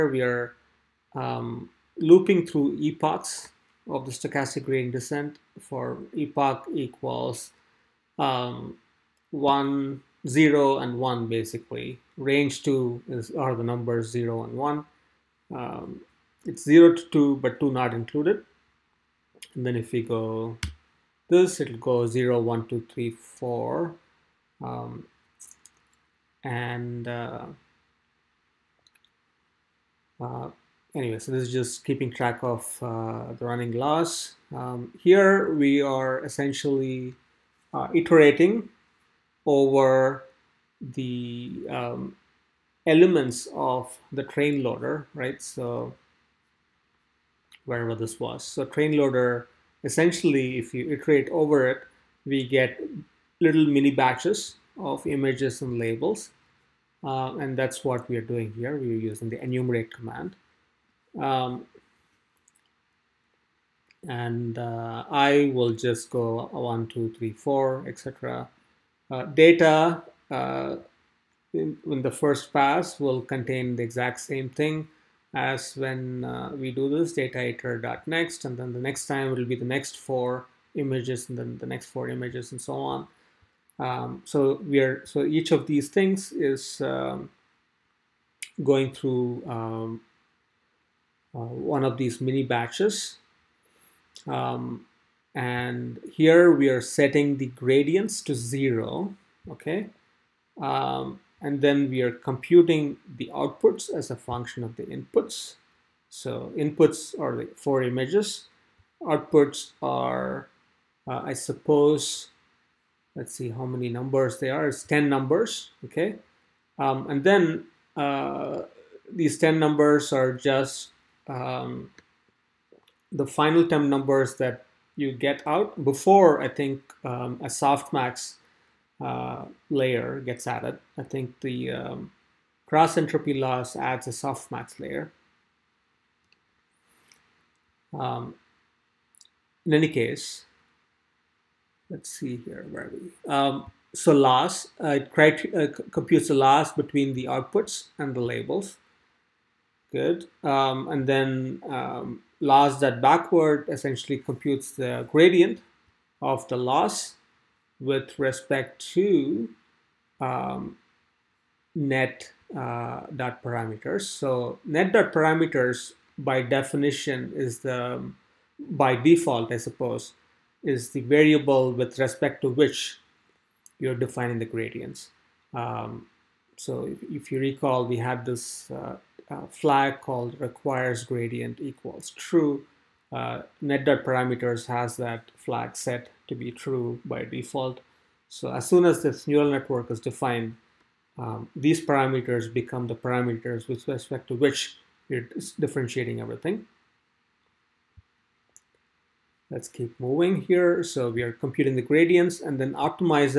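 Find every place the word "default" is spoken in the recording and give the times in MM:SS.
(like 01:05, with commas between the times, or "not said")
02:48, 03:07.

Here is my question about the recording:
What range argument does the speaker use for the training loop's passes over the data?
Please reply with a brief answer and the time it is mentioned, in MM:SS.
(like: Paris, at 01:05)
Range 2, at 00:12.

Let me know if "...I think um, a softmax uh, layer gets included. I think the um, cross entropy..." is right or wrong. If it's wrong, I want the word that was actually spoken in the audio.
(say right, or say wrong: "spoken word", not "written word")
wrong: "added", not "included".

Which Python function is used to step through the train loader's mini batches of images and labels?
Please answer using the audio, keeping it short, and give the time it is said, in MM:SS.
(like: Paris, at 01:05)
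enumerate, at 00:59.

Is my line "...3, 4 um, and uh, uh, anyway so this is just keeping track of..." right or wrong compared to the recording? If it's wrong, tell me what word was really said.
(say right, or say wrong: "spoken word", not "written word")
right.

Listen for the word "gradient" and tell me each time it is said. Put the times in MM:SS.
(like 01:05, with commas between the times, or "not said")
00:04, 01:37, 02:35, 02:54, 03:01, 03:21.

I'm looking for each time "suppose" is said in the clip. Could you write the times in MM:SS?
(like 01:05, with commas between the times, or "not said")
01:51, 02:49.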